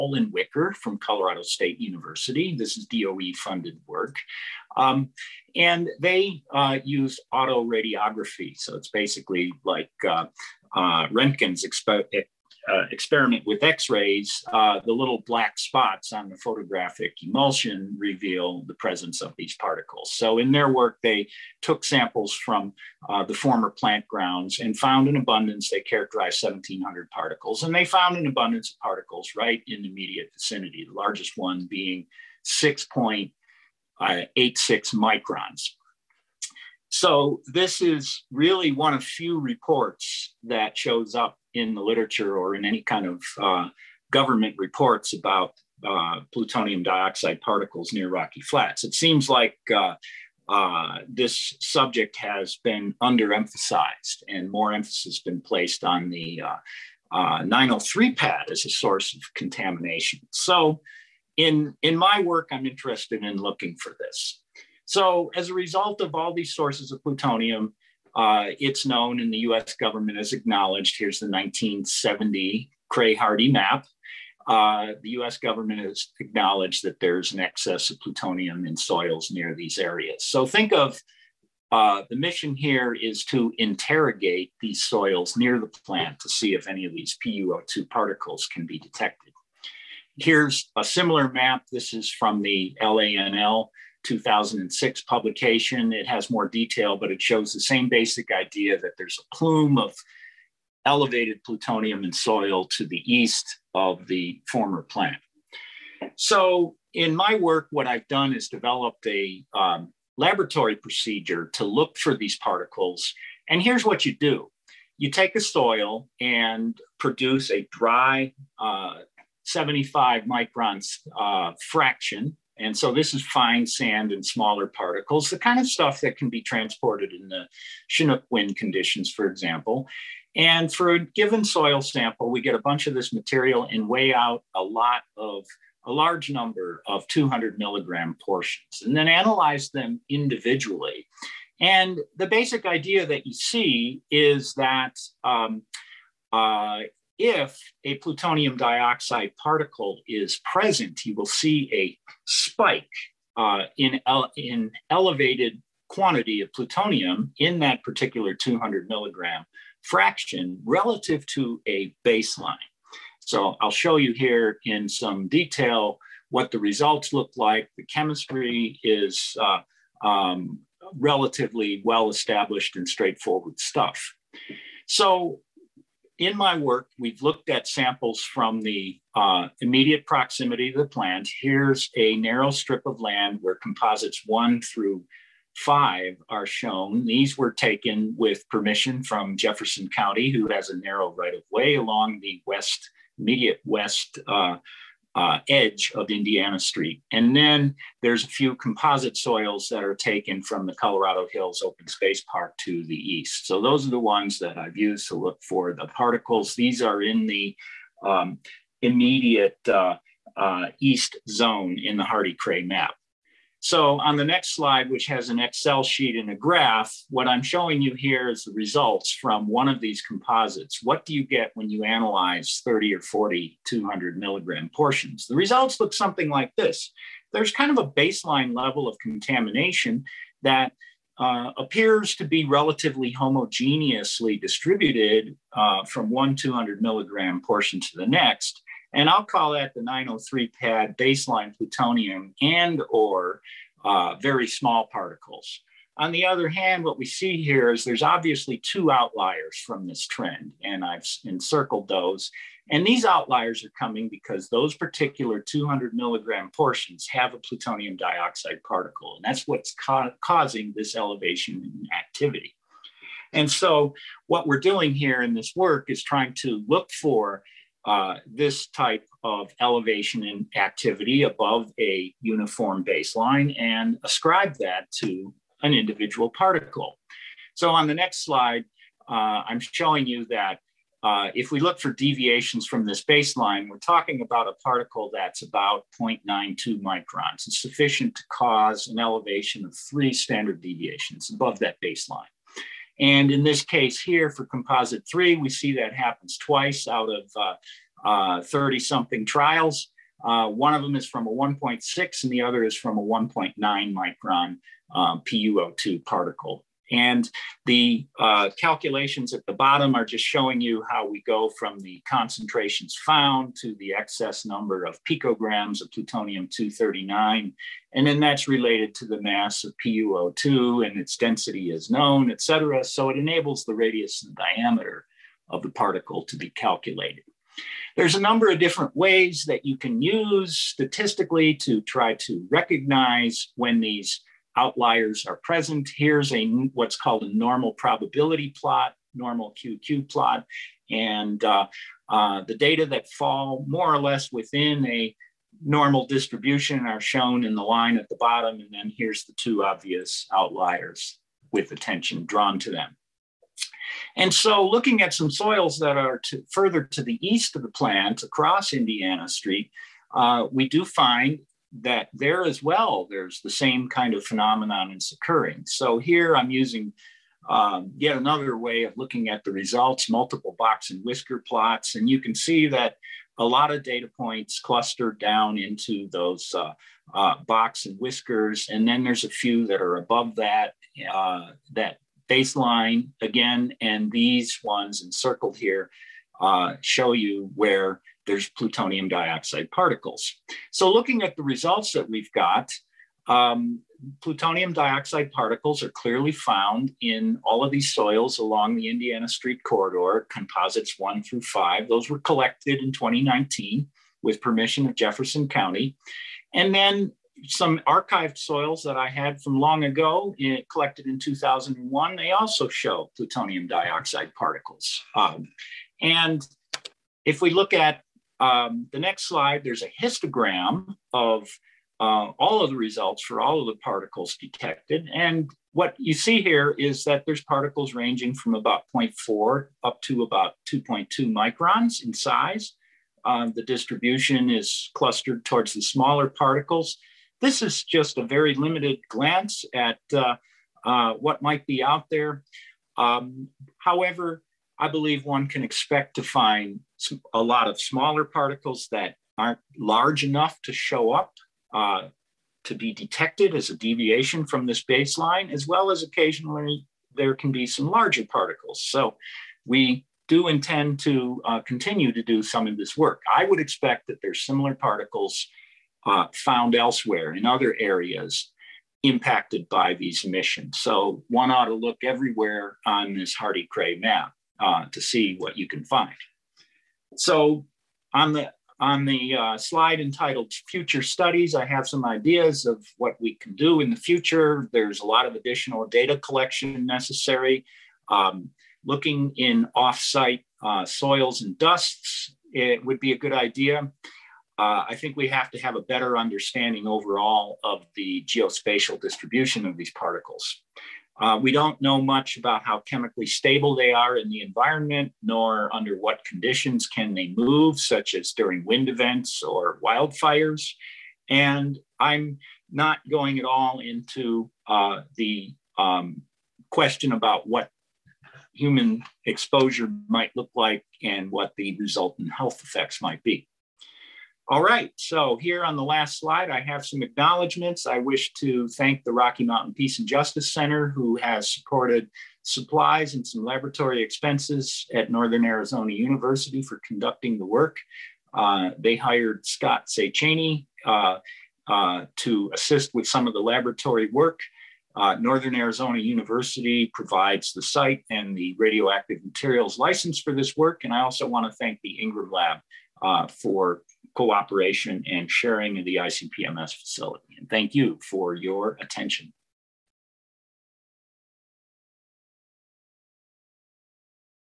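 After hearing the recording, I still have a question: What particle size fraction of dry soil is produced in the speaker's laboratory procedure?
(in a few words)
75 microns.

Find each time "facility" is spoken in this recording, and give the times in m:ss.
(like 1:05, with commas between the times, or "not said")
9:16.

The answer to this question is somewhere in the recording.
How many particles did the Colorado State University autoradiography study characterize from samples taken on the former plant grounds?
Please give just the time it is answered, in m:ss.
0:26.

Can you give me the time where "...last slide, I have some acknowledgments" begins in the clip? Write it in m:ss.
8:45.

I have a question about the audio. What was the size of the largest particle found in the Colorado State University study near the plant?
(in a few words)
6.86 microns.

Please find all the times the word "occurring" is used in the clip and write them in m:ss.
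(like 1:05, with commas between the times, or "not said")
6:05.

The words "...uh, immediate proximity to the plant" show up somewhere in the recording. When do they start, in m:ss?
2:59.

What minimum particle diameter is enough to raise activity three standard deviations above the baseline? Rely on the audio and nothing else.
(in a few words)
0.92 microns.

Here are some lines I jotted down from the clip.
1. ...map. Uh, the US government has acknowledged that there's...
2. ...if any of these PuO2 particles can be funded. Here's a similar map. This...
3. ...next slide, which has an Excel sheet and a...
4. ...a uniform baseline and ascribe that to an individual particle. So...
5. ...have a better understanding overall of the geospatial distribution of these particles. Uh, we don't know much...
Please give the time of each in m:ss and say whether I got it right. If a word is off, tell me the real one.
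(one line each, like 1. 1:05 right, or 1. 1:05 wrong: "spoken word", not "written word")
1. 1:13 right
2. 1:26 wrong: "detected", not "funded"
3. 3:34 right
4. 4:31 right
5. 8:15 right.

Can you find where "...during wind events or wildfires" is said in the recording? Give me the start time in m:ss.
8:28.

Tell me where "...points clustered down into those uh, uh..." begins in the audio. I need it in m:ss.
6:14.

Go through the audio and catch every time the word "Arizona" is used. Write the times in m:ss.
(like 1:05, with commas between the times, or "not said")
8:55, 9:05.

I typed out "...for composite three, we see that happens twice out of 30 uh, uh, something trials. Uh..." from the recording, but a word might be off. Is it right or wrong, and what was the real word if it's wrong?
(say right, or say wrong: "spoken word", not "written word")
right.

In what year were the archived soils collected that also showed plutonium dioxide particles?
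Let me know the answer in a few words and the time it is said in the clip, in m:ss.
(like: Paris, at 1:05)
2001, at 6:51.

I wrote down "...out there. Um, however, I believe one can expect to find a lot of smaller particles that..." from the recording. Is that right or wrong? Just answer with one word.
right.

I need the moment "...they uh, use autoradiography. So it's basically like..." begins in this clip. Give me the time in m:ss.
0:05.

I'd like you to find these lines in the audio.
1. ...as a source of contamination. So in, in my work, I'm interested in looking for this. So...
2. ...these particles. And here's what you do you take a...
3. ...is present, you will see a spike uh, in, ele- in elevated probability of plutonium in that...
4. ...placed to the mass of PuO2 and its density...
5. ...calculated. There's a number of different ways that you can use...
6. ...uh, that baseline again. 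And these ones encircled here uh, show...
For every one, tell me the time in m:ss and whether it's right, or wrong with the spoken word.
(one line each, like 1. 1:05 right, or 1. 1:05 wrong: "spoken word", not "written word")
1. 0:58 right
2. 1:52 right
3. 2:30 wrong: "quantity", not "probability"
4. 5:18 wrong: "related", not "placed"
5. 5:26 right
6. 6:21 right.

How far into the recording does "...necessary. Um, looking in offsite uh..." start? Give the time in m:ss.
8:06.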